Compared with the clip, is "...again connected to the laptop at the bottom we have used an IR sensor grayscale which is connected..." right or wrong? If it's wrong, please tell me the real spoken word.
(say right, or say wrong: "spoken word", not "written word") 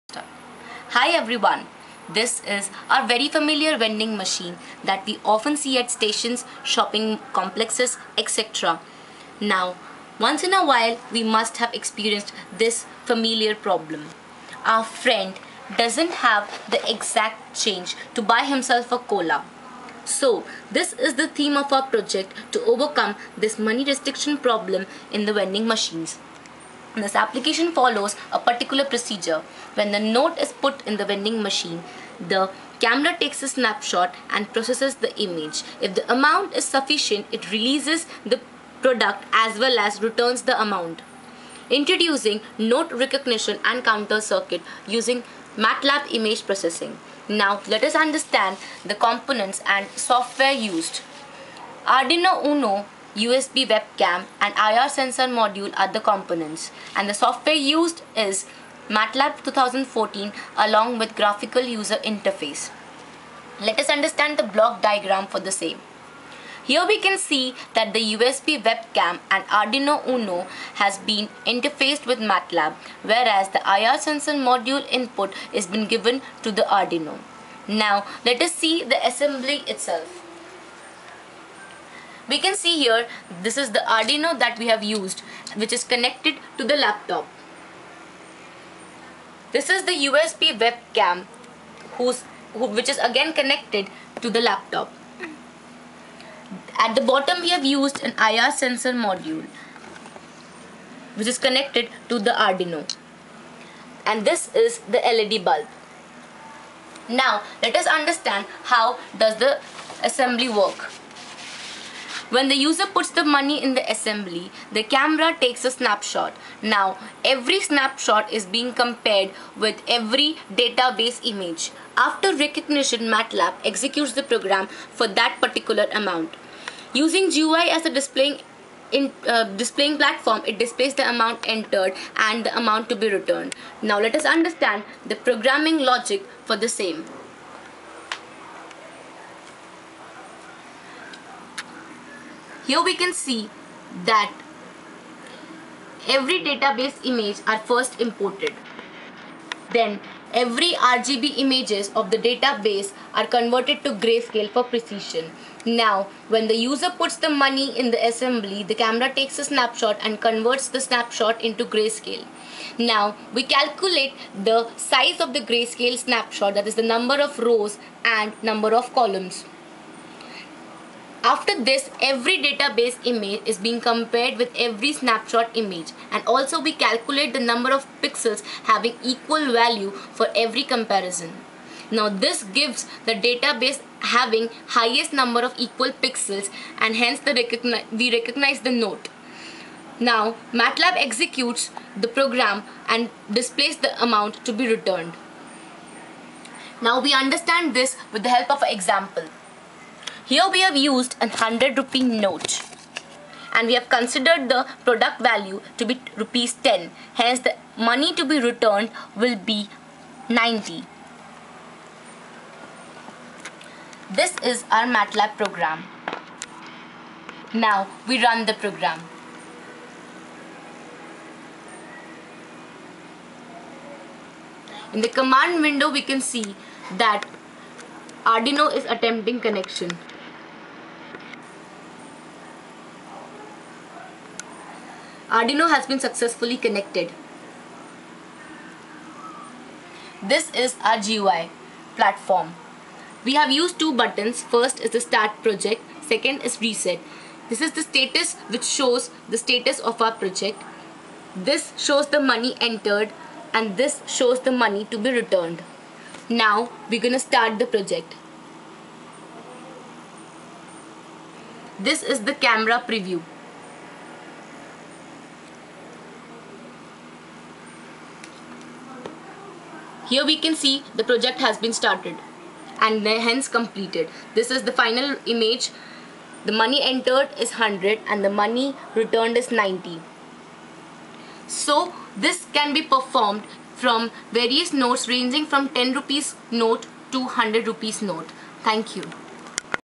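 wrong: "module", not "grayscale".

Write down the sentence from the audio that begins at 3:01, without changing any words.
Now this gives the database having highest number of equal pixels and hence the recogni we recognize the note.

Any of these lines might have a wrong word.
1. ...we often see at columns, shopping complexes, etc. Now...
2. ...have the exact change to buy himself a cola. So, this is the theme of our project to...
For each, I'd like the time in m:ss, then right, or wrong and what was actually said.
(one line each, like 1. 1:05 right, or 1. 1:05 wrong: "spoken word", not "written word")
1. 0:05 wrong: "stations", not "columns"
2. 0:16 right.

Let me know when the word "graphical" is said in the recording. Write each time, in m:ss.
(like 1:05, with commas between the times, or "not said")
1:01.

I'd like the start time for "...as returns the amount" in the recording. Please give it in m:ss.
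0:39.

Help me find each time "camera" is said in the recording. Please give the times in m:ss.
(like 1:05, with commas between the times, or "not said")
0:32, 1:54, 2:38, 4:22.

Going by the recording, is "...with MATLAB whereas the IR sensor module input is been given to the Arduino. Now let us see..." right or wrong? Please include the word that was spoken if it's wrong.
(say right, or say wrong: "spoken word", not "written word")
right.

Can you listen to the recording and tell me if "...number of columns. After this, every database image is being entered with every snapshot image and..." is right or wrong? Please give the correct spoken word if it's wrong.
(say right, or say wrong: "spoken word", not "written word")
wrong: "compared", not "entered".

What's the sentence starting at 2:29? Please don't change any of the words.
Then every RGB images of the database are converted to grayscale for precision.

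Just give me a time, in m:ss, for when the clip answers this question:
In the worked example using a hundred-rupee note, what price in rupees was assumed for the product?
3:26.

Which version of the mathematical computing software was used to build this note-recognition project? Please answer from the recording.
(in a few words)
MATLAB 2014.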